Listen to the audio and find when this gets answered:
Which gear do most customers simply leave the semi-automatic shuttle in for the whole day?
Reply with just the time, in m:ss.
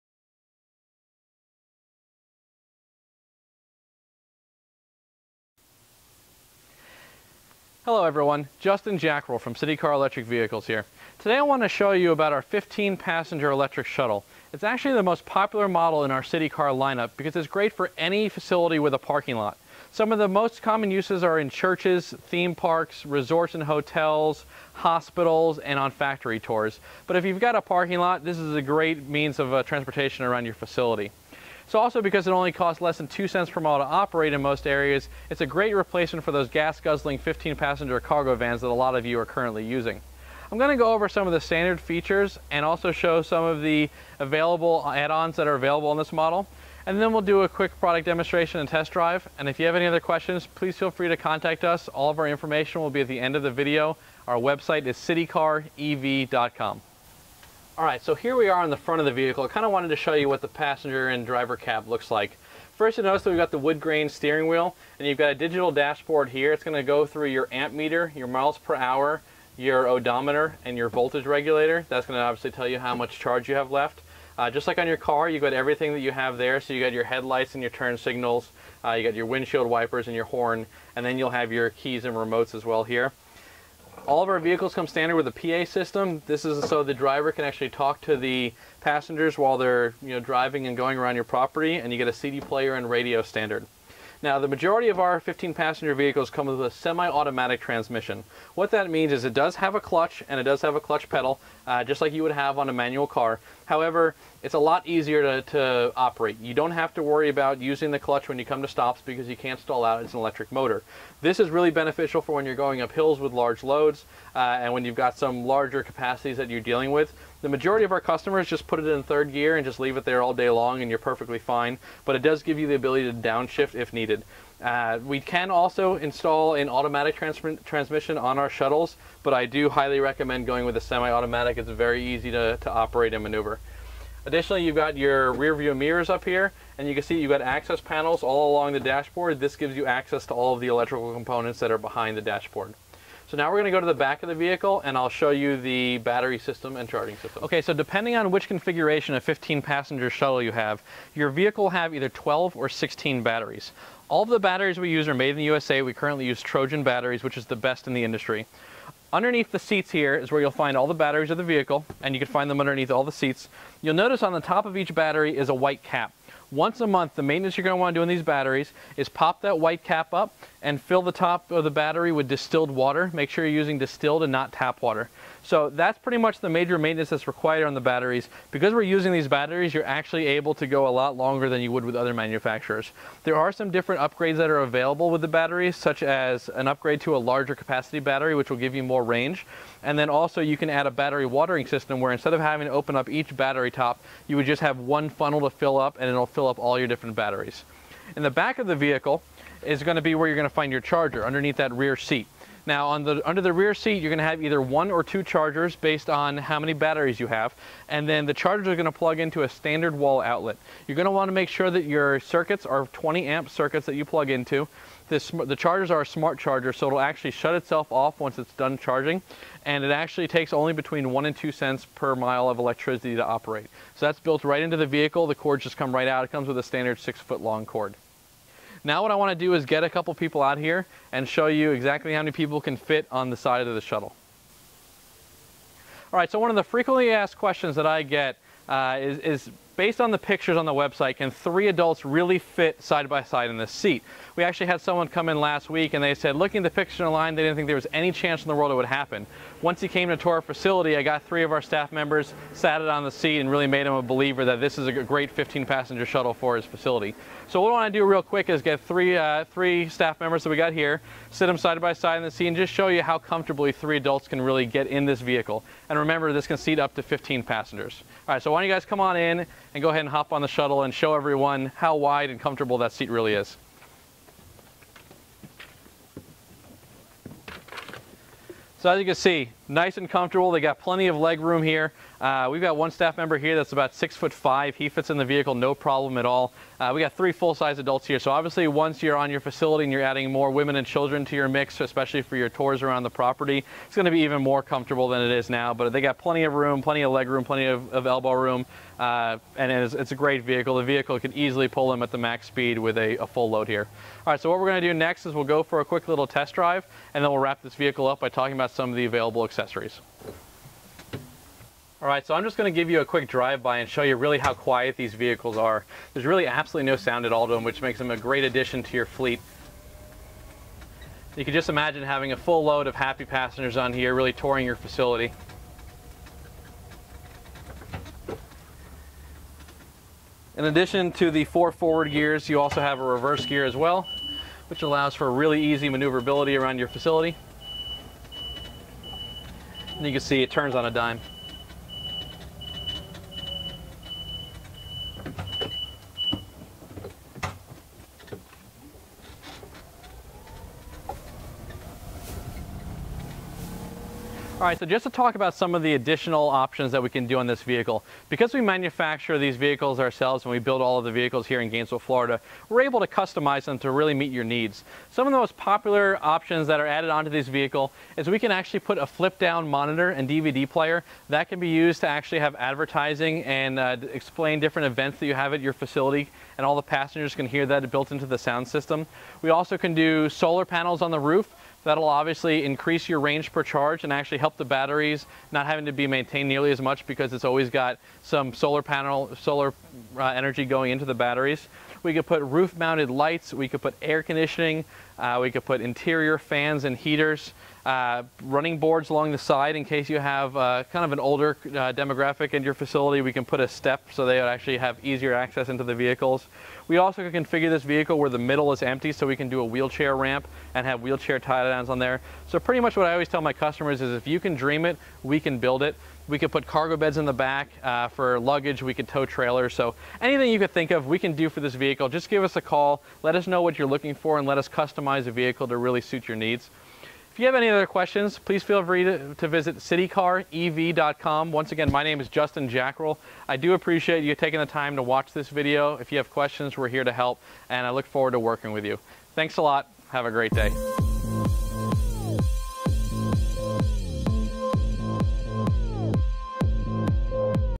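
1:59.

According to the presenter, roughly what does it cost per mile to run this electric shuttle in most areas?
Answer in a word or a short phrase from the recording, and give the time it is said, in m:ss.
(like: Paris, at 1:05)
less than 2 cents, at 0:32.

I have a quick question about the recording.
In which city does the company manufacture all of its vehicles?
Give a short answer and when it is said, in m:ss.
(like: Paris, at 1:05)
Gainesville, Florida, at 6:01.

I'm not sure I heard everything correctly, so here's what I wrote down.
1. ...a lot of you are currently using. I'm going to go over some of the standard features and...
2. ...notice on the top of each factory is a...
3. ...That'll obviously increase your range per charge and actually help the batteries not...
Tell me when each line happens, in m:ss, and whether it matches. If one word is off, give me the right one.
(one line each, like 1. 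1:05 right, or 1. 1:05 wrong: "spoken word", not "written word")
1. 0:38 right
2. 2:43 wrong: "battery", not "factory"
3. 6:21 right.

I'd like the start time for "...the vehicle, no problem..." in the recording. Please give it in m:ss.
4:45.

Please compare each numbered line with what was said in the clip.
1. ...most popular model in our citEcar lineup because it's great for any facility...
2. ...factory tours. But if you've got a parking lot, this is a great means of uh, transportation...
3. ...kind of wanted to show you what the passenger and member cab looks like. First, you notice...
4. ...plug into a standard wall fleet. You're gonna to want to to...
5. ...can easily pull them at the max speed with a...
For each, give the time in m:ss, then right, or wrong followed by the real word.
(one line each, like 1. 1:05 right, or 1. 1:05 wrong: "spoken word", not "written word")
1. 0:15 right
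2. 0:25 right
3. 0:59 wrong: "driver", not "member"
4. 3:28 wrong: "outlet", not "fleet"
5. 5:01 right.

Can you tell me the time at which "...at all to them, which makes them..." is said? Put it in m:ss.
5:17.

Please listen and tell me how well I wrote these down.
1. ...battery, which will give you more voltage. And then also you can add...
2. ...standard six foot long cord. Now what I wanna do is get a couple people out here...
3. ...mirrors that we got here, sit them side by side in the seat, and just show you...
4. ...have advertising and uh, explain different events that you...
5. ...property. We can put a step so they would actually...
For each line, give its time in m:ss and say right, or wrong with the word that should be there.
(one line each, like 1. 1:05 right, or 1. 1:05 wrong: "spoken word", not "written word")
1. 3:07 wrong: "range", not "voltage"
2. 3:46 right
3. 4:20 wrong: "members", not "mirrors"
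4. 6:12 right
5. 6:42 wrong: "facility", not "property".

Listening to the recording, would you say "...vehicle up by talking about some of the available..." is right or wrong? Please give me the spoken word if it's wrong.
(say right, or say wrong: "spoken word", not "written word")
right.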